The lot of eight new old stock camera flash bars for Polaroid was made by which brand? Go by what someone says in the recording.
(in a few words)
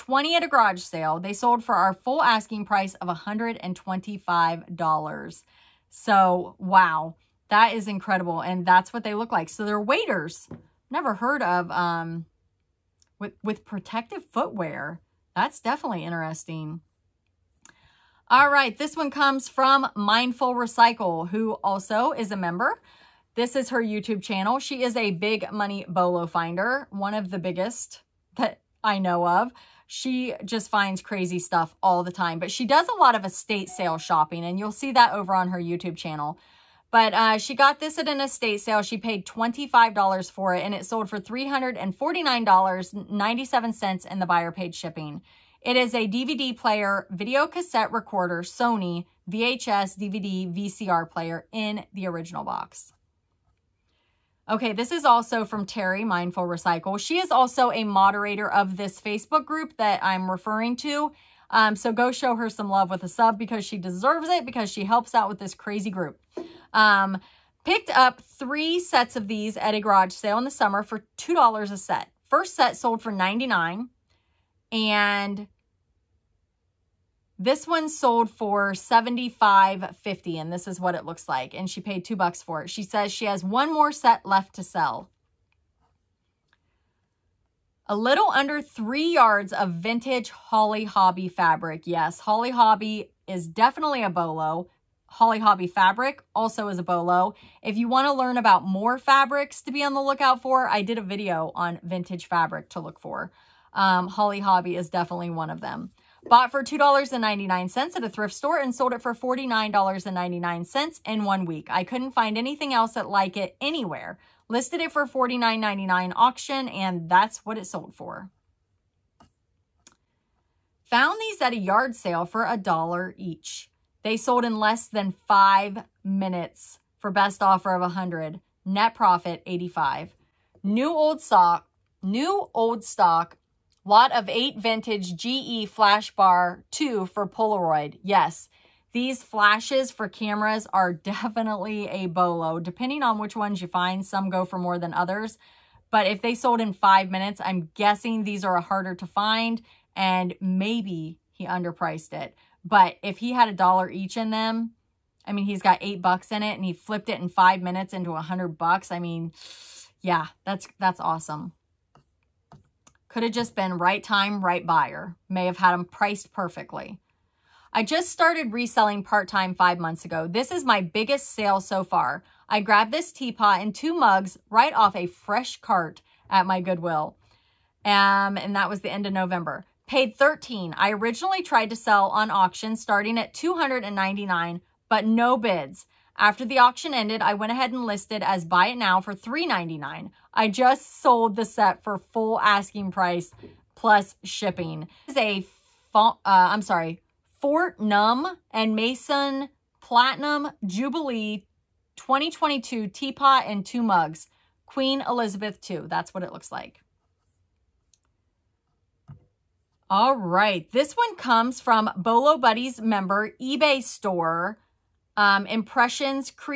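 GE.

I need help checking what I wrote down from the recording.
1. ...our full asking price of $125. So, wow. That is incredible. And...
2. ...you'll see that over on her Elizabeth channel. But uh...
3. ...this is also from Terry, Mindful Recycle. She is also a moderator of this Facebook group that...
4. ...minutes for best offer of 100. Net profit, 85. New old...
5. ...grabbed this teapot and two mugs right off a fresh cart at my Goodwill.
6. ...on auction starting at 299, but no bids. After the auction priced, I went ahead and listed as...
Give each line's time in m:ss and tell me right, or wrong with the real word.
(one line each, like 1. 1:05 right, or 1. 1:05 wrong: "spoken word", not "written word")
1. 0:01 right
2. 0:34 wrong: "YouTube", not "Elizabeth"
3. 0:54 right
4. 2:06 right
5. 2:52 right
6. 3:02 wrong: "ended", not "priced".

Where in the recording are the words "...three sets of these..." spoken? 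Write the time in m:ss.
1:08.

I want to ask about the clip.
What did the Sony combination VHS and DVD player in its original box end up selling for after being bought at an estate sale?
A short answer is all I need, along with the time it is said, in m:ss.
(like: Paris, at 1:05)
$349.97, at 0:41.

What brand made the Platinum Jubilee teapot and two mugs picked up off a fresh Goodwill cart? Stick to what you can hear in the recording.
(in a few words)
Fortnum and Mason.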